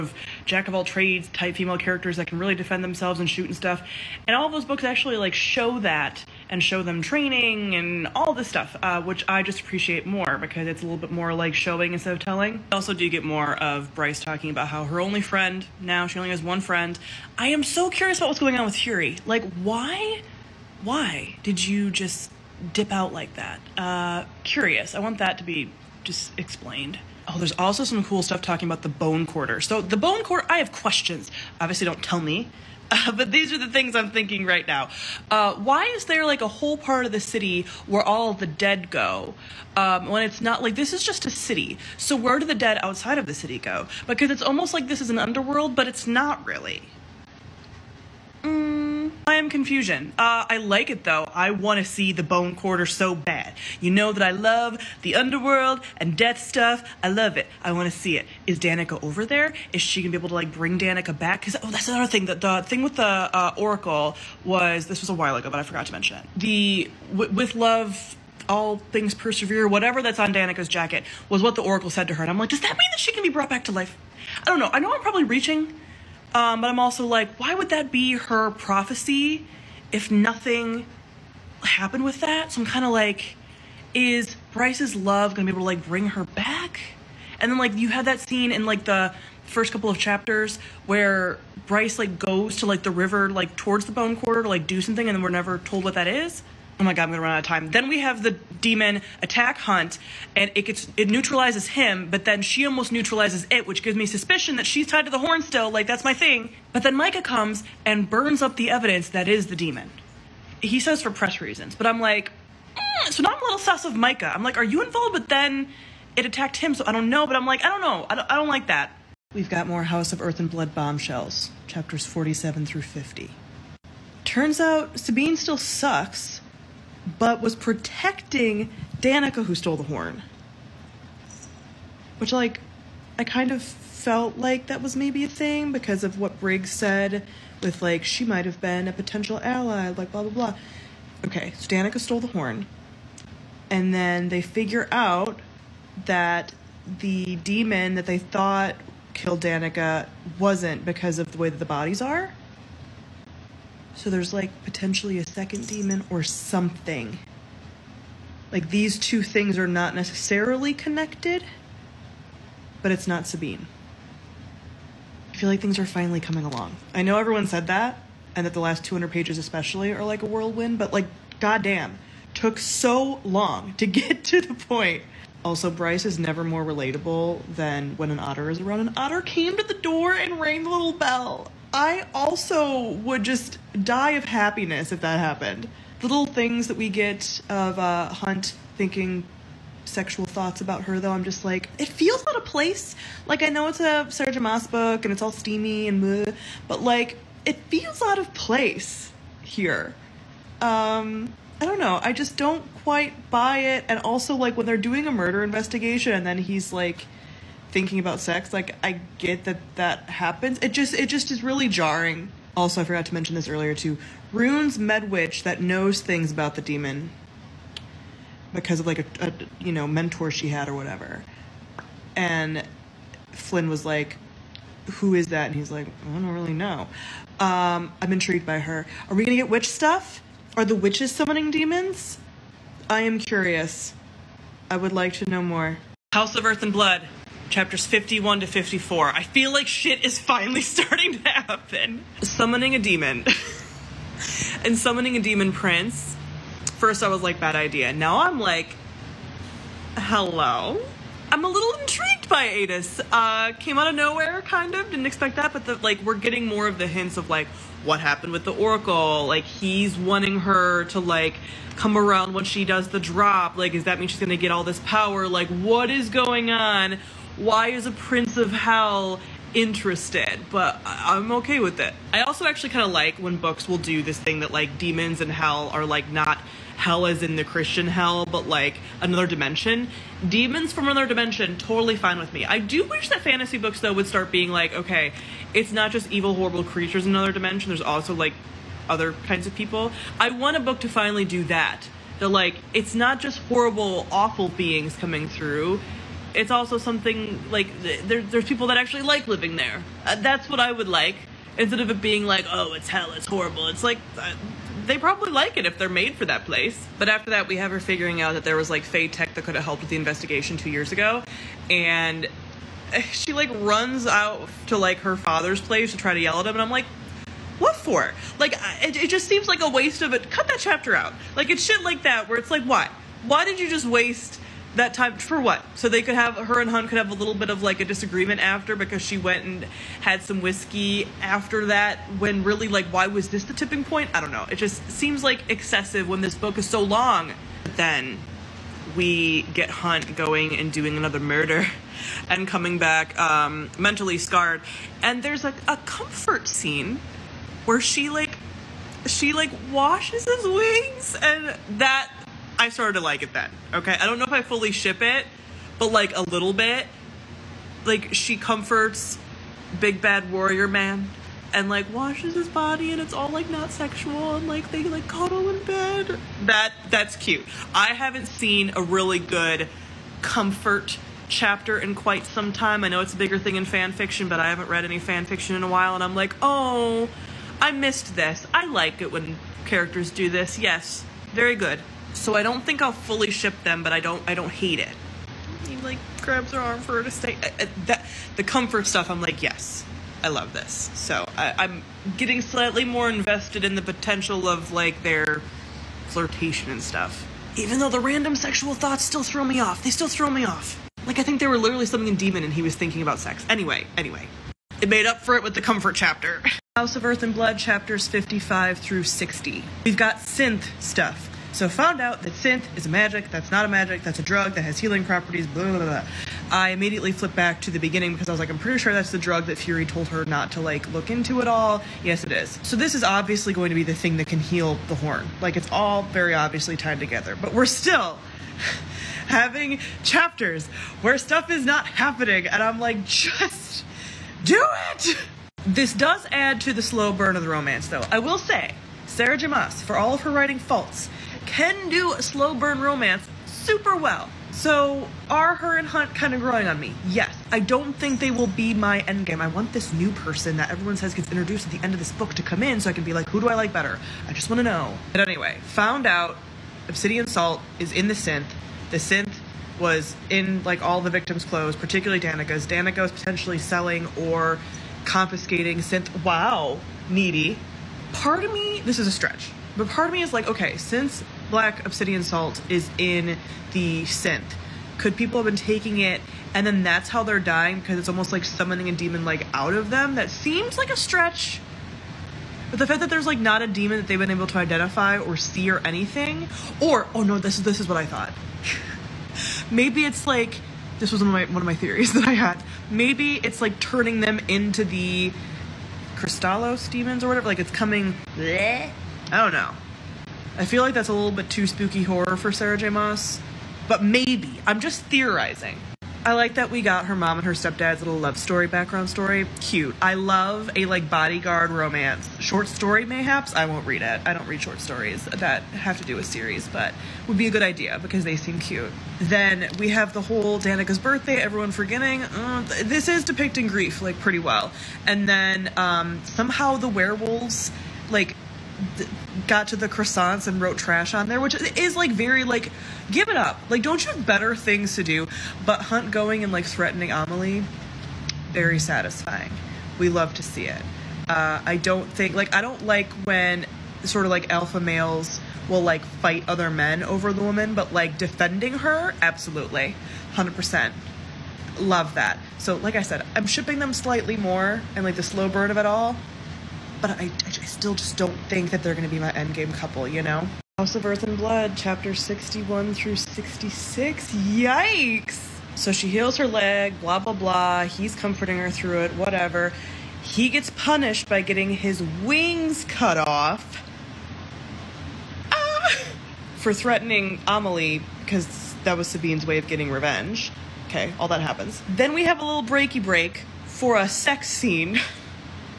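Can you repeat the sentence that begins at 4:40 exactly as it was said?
Demons from another dimension, totally fine with me.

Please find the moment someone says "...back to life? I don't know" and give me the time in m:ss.
1:13.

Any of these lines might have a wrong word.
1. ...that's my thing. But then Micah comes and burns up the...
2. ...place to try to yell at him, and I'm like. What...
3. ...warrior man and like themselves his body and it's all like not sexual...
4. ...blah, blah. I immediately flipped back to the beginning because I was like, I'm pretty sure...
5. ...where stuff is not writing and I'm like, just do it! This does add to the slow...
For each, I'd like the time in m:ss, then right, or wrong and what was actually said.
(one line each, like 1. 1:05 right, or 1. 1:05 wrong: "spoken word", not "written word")
1. 1:45 right
2. 5:15 right
3. 6:00 wrong: "washes", not "themselves"
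4. 6:55 right
5. 7:11 wrong: "happening", not "writing".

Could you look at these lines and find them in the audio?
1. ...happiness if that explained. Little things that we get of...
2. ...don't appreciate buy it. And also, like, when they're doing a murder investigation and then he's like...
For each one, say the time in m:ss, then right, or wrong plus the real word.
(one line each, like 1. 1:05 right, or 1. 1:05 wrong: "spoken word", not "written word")
1. 3:04 wrong: "happened", not "explained"
2. 3:22 wrong: "quite", not "appreciate".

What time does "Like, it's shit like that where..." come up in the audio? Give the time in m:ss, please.
5:21.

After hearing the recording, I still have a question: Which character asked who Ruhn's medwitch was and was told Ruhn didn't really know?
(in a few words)
Flynn.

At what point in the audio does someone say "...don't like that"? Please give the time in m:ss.
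1:58.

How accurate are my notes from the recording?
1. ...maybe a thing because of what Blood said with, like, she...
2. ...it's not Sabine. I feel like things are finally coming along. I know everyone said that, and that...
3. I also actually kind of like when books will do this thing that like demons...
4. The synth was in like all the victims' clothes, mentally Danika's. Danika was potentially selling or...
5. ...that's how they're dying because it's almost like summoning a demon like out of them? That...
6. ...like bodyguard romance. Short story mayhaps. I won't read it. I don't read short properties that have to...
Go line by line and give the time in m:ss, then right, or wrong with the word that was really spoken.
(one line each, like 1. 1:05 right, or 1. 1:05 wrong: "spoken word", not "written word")
1. 2:14 wrong: "Briggs", not "Blood"
2. 2:42 right
3. 4:32 right
4. 7:38 wrong: "particularly", not "mentally"
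5. 7:56 right
6. 8:30 wrong: "stories", not "properties".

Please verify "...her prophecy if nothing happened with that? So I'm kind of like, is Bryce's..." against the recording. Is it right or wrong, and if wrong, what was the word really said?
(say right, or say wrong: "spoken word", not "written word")
right.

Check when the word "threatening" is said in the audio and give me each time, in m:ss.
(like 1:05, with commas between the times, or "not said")
8:56, 9:36.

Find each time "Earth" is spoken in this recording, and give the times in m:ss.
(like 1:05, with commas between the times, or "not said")
2:00, 3:56, 6:47, 9:21.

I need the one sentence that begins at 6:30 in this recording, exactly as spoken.
So I, am getting slightly more invested in the potential of like their flirtation and stuff.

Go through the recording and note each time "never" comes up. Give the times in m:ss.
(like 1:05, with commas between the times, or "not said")
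1:35, 2:56.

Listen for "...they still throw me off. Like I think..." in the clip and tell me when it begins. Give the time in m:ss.
6:39.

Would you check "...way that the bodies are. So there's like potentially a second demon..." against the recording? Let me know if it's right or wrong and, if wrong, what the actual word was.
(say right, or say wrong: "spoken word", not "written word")
right.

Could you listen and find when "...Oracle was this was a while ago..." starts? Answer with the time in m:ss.
1:03.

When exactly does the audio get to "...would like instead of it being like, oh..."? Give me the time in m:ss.
5:00.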